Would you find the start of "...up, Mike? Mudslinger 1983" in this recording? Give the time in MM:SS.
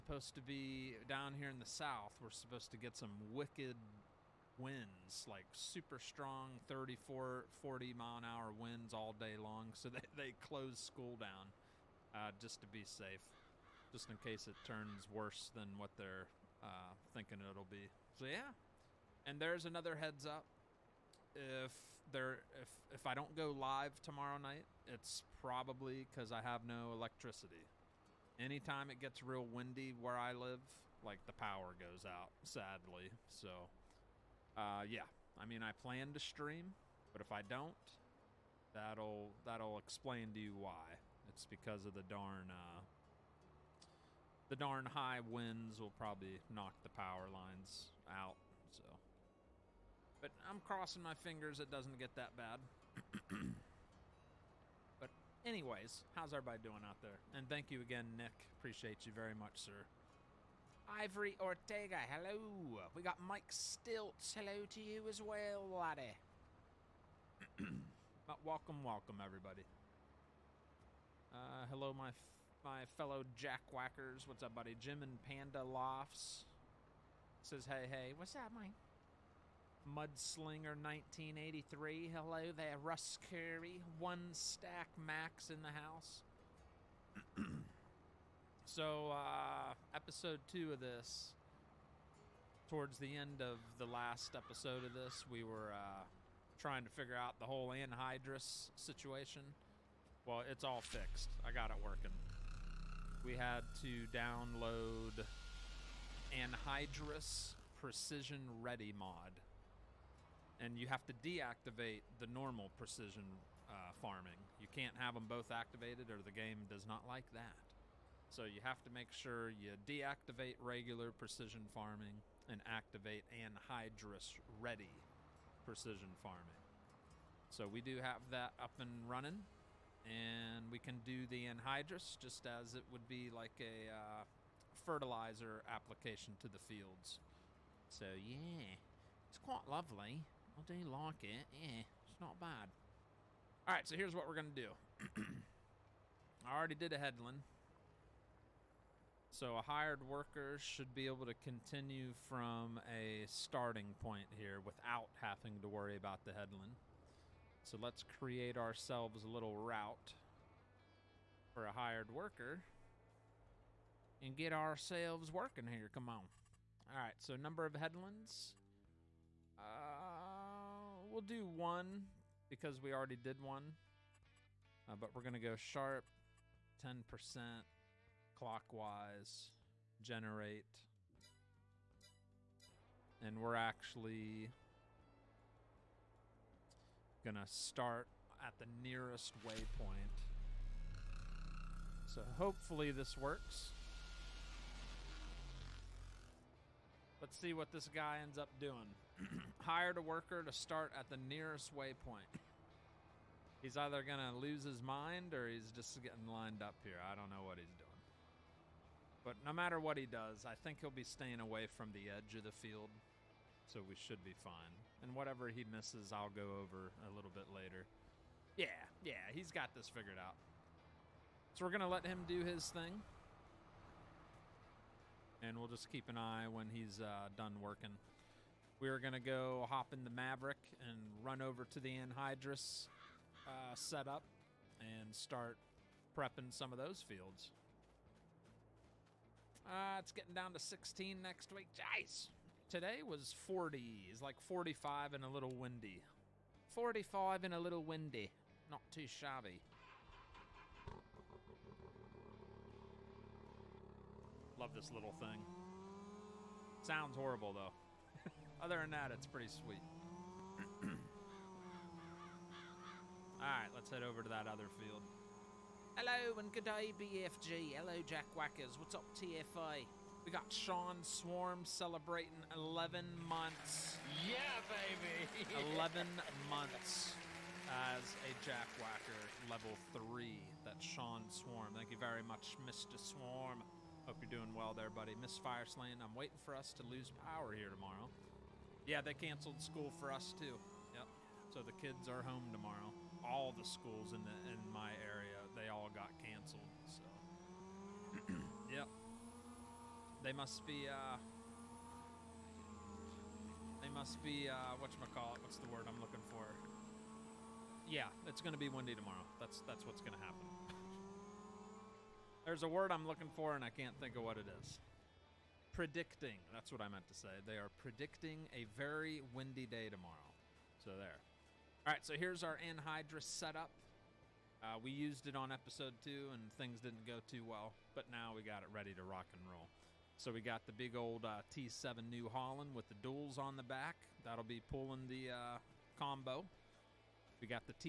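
01:18.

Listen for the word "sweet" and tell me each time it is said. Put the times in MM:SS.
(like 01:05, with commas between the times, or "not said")
04:19.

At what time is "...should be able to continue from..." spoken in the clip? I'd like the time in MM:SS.
02:30.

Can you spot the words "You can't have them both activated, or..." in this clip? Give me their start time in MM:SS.
01:54.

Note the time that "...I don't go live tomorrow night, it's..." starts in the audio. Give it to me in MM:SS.
00:23.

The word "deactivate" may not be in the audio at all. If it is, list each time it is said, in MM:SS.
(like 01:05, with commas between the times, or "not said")
01:51, 01:59.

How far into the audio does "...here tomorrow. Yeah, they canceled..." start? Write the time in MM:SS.
04:47.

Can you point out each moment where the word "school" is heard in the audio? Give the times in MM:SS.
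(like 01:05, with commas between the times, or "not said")
00:10, 04:49, 04:53.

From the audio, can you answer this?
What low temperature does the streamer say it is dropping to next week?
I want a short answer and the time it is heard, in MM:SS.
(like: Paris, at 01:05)
16, at 04:00.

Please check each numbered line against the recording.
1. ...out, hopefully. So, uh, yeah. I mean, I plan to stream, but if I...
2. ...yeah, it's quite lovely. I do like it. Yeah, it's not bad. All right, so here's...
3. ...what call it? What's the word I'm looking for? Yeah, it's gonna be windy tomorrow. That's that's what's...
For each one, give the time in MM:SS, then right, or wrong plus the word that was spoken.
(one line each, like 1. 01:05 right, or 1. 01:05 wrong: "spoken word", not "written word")
1. 00:32 wrong: "sadly", not "hopefully"
2. 02:18 right
3. 05:04 right.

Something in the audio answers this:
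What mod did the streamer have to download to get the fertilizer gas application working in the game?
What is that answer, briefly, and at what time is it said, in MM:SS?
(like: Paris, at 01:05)
Anhydrous precision ready mod, at 01:46.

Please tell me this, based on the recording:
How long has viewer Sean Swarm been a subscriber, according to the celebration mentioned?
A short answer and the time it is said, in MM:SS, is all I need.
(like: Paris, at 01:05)
11 months, at 04:32.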